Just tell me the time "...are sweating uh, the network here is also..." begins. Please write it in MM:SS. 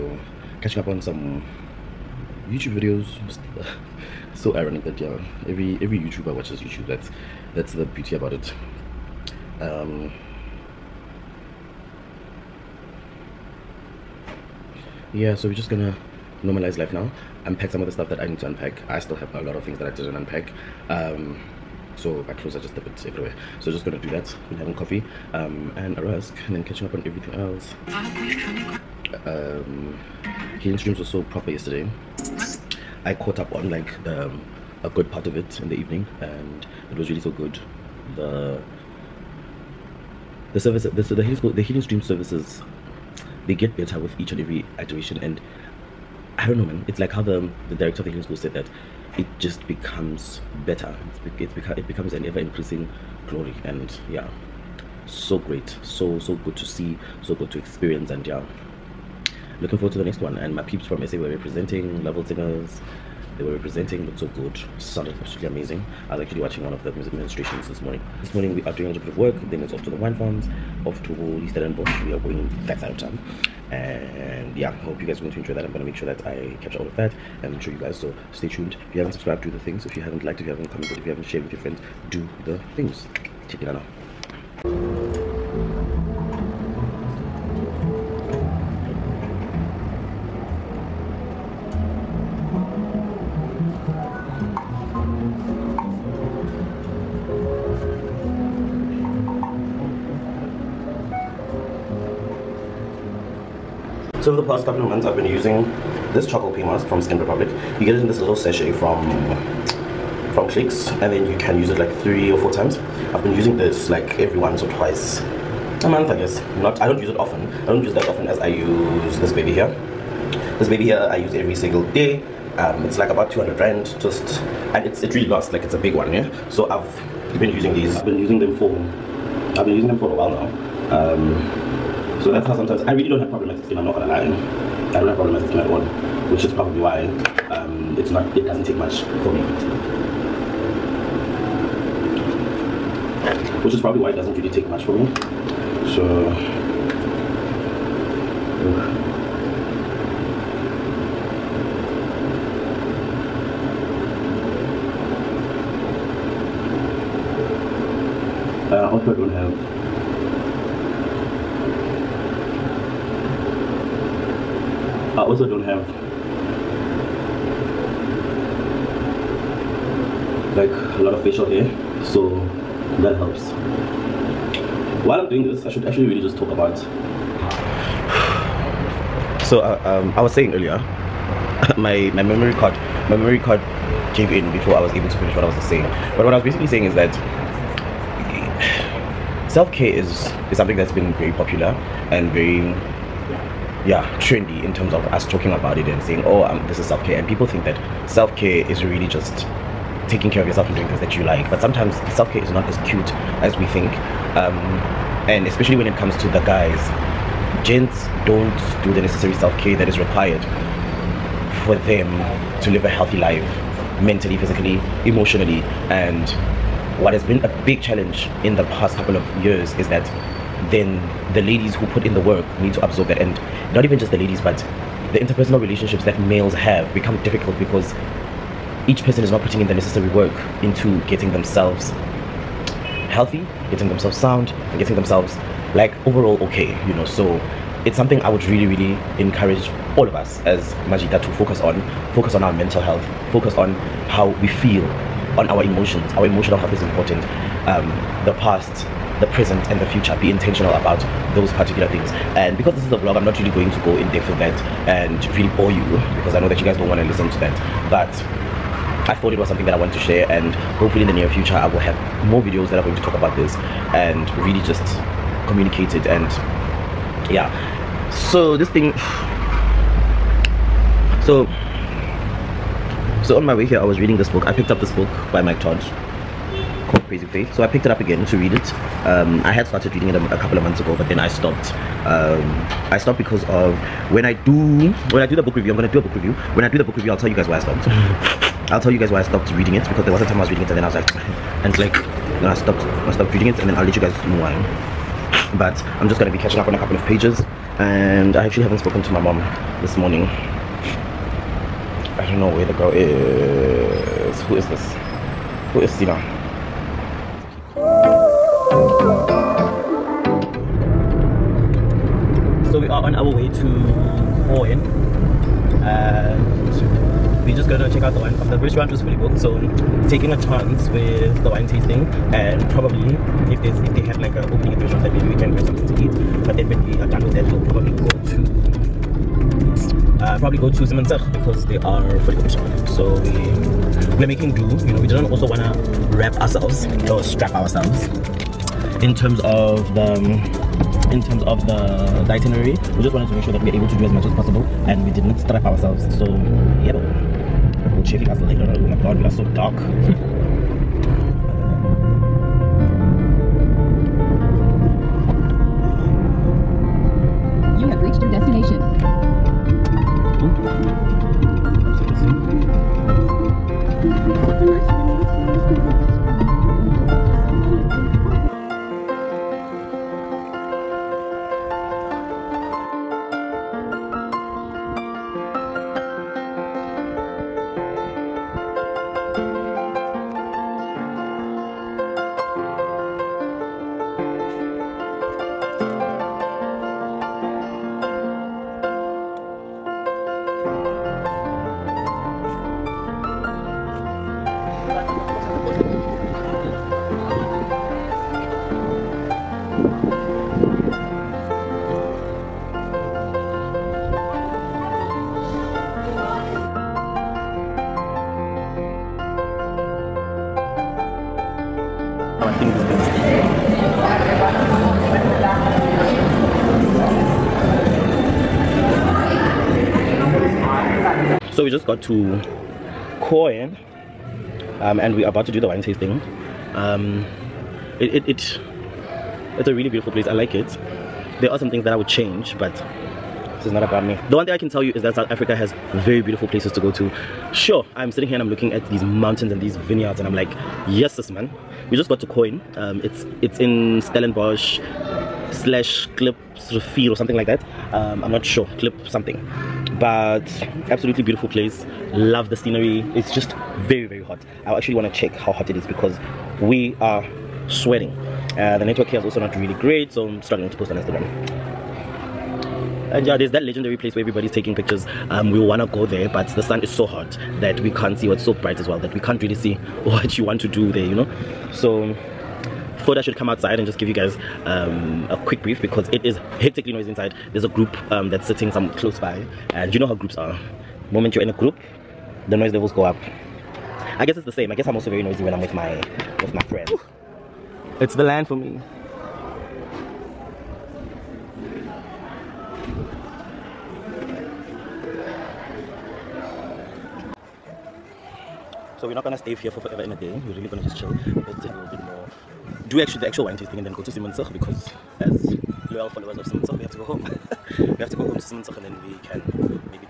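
07:36.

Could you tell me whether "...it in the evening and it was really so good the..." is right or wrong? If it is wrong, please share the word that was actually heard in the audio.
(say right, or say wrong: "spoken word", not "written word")
right.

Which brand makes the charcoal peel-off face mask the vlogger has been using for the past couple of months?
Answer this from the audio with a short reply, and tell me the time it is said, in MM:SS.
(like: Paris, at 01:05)
Skin Republic, at 01:47.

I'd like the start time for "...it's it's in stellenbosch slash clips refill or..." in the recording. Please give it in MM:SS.
07:23.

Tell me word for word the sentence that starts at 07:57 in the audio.
There's a group um, that's sitting some close by, and you know how groups are.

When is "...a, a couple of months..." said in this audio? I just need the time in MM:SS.
04:40.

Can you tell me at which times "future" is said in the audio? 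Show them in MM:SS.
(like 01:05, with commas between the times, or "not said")
04:09, 04:21.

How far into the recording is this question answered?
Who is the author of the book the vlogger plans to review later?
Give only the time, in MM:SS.
04:35.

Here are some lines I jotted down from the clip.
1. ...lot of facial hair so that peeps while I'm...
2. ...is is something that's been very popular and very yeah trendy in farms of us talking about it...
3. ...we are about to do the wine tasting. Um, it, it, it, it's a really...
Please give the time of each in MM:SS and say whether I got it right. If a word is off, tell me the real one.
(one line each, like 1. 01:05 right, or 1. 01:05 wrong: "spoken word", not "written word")
1. 02:51 wrong: "helps", not "peeps"
2. 03:09 wrong: "terms", not "farms"
3. 07:05 right.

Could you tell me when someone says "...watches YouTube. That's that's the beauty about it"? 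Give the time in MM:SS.
00:06.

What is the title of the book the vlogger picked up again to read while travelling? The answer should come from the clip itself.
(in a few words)
Crazy Faith.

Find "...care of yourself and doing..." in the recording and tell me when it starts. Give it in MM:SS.
03:20.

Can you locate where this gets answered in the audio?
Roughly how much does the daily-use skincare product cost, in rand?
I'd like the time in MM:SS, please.
02:03.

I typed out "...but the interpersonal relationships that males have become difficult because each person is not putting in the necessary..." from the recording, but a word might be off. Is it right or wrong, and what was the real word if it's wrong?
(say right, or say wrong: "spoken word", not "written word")
right.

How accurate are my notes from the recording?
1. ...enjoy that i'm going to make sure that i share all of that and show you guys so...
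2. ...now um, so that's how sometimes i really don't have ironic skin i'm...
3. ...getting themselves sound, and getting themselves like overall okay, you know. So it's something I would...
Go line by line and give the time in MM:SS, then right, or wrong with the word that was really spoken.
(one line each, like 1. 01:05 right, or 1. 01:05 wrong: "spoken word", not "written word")
1. 01:15 wrong: "capture", not "share"
2. 02:10 wrong: "problematic", not "ironic"
3. 03:53 right.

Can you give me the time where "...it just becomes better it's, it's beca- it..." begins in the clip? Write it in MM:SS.
00:49.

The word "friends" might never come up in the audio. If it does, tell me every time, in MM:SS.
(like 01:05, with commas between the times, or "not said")
01:21, 08:06.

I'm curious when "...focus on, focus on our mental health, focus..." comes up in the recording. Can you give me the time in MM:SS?
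04:01.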